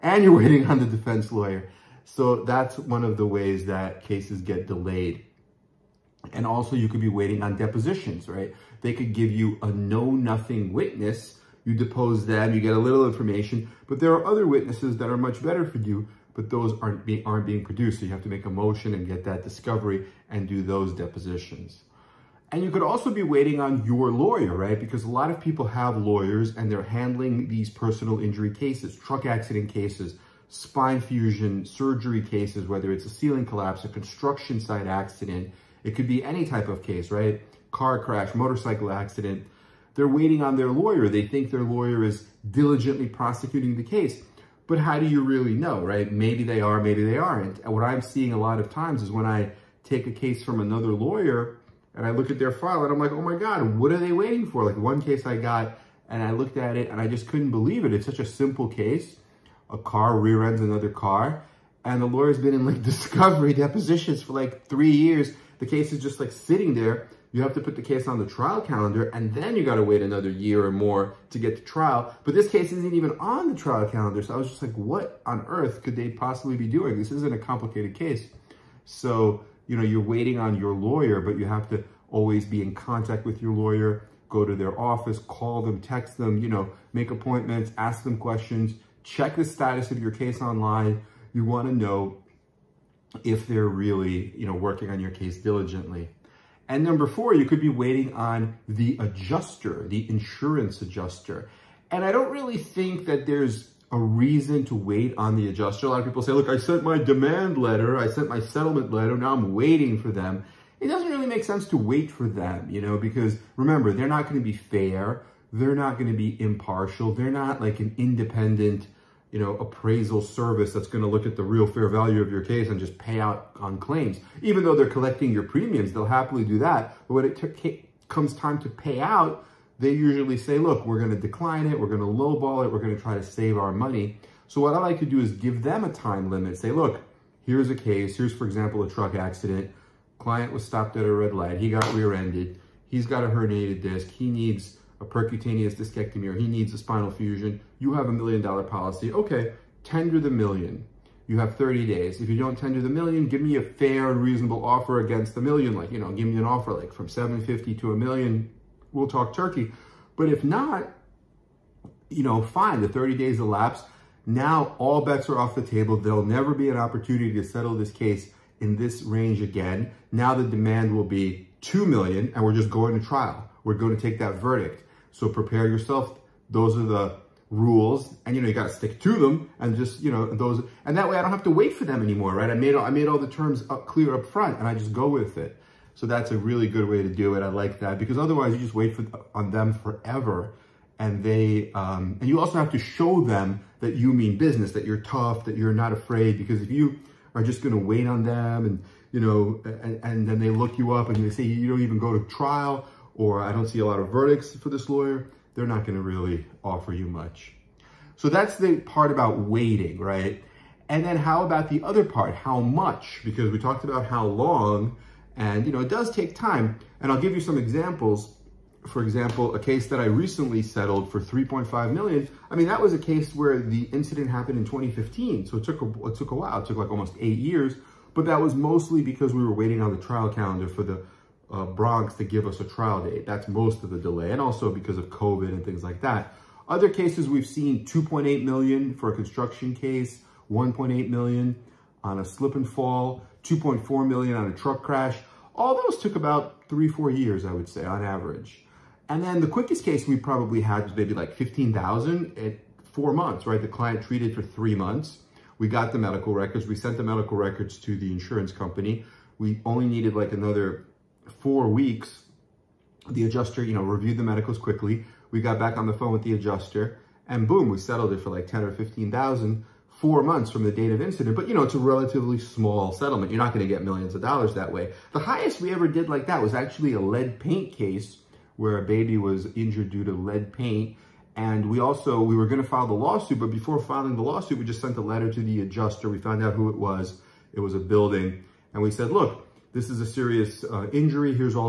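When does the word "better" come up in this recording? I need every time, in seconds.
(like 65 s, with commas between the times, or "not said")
15 s.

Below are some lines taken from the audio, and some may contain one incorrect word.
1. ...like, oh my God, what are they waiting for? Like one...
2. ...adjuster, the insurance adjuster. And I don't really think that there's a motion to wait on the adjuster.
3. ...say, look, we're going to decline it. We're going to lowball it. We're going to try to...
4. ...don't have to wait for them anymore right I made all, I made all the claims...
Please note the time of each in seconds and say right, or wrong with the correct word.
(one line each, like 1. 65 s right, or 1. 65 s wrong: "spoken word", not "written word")
1. 52 s right
2. 98 s wrong: "reason", not "motion"
3. 130 s right
4. 181 s wrong: "terms", not "claims".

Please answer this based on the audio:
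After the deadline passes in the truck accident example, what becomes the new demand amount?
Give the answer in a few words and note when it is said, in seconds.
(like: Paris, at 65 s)
2 million, at 171 s.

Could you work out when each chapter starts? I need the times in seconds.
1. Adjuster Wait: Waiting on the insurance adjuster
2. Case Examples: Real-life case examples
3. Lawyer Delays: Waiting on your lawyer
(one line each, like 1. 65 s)
1. 89 s
2. 205 s
3. 17 s.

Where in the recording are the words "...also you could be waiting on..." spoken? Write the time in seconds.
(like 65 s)
6 s.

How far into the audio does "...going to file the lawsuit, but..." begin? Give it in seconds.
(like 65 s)
282 s.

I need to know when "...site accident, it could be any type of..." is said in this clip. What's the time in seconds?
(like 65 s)
34 s.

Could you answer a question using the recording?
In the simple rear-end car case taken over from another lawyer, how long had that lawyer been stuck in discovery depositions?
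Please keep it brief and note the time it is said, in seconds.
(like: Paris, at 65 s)
3 years, at 64 s.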